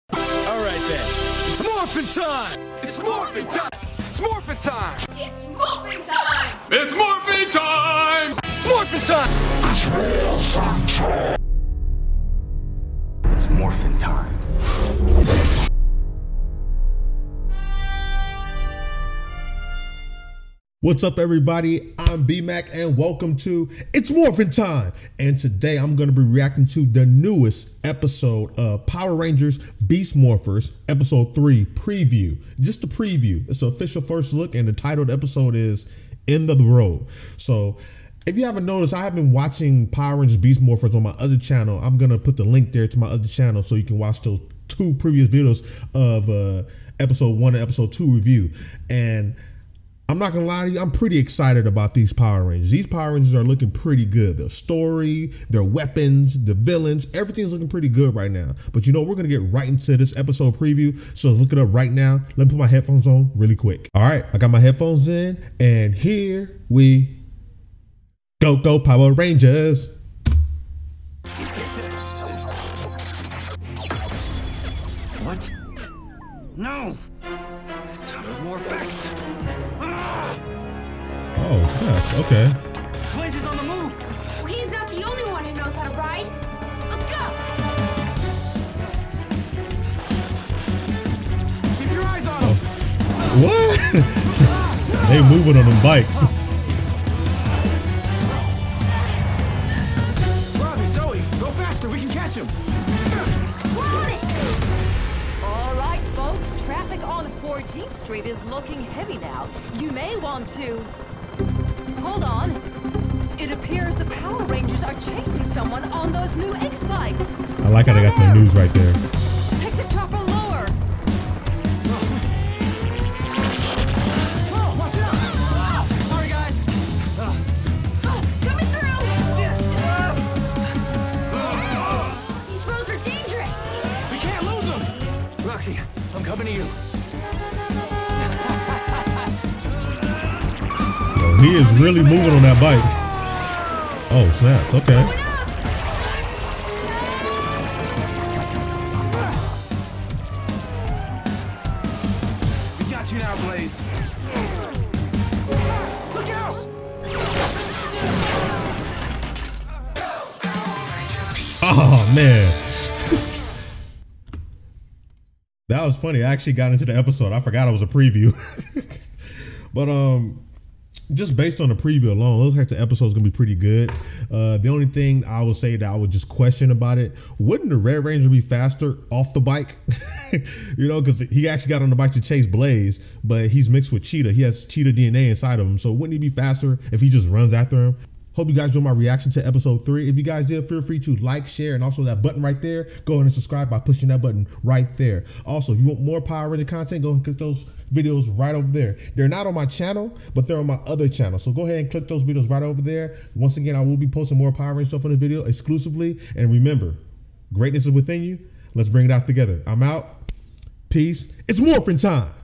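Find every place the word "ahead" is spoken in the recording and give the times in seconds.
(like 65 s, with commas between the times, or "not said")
193 s, 201 s.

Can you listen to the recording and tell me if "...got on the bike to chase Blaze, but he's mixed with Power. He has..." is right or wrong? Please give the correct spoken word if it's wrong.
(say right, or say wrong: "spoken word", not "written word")
wrong: "Cheetah", not "Power".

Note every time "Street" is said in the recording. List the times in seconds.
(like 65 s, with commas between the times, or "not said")
107 s.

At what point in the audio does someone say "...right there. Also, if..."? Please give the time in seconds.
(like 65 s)
194 s.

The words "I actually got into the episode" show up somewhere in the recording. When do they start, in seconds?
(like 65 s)
166 s.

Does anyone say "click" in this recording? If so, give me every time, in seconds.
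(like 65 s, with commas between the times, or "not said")
197 s, 201 s.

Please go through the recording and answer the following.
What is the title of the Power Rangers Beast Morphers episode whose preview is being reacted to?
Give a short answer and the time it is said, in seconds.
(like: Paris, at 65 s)
End of the Road, at 36 s.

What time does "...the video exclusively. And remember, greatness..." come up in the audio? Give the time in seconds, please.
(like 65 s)
205 s.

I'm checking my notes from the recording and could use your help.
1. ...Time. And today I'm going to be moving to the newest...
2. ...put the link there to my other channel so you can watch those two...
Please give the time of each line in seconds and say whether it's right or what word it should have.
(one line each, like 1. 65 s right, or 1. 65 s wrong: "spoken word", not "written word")
1. 24 s wrong: "reacting", not "moving"
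2. 42 s right.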